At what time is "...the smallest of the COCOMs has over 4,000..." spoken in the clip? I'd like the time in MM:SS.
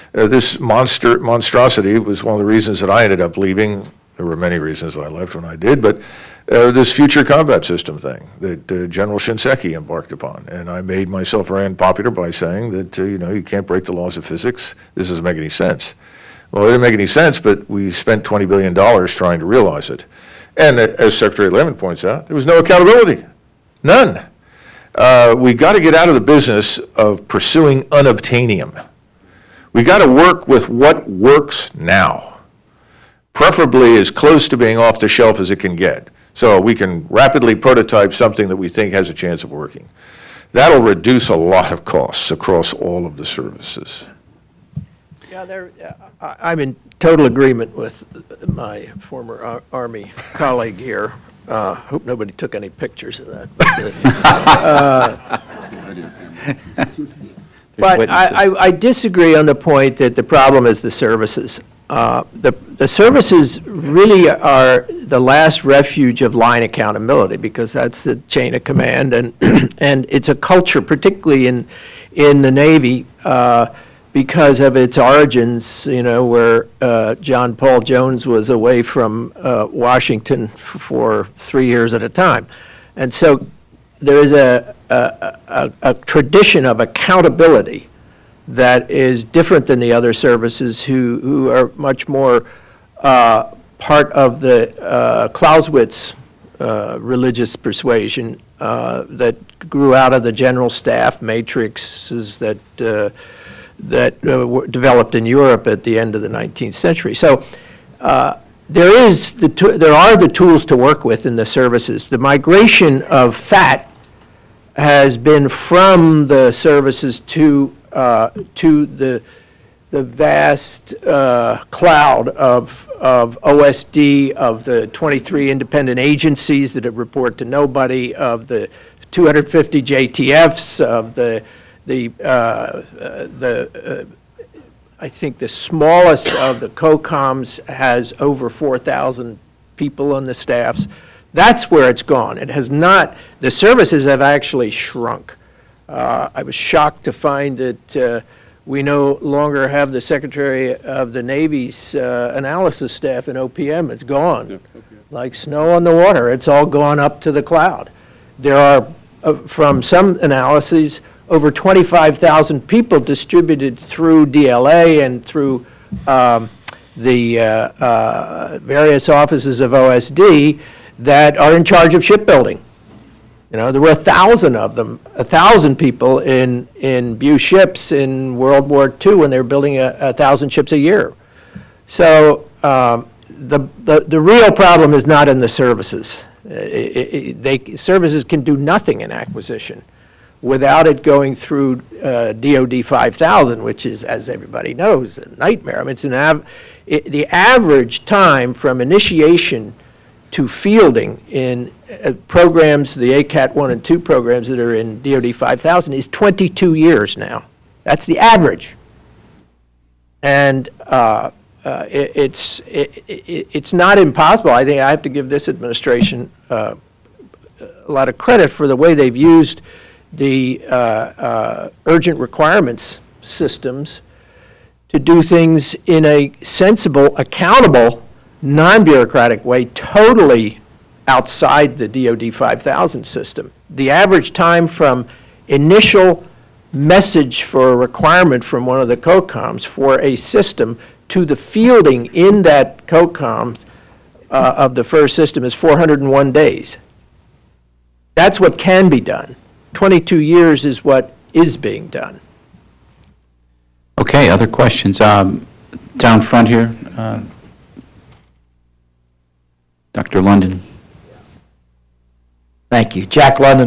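02:15.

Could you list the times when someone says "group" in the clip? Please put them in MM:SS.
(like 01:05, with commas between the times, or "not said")
not said.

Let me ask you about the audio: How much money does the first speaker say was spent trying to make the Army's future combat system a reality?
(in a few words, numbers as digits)
$20 billion.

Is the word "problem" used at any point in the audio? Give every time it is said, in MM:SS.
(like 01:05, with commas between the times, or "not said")
01:00, 03:04.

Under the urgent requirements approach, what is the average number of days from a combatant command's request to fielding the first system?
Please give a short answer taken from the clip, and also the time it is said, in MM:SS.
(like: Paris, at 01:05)
401 days, at 04:05.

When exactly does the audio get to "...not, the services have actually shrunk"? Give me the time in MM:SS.
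02:22.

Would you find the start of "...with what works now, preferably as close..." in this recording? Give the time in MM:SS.
00:30.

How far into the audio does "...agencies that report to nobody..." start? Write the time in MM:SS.
02:05.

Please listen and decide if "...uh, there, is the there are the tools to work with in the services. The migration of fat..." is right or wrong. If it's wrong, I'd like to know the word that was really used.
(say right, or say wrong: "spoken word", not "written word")
right.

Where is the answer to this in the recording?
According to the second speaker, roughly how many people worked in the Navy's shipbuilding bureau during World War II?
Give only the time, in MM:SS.
02:55.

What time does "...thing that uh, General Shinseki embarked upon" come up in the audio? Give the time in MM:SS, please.
00:07.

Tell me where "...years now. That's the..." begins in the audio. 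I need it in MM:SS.
03:26.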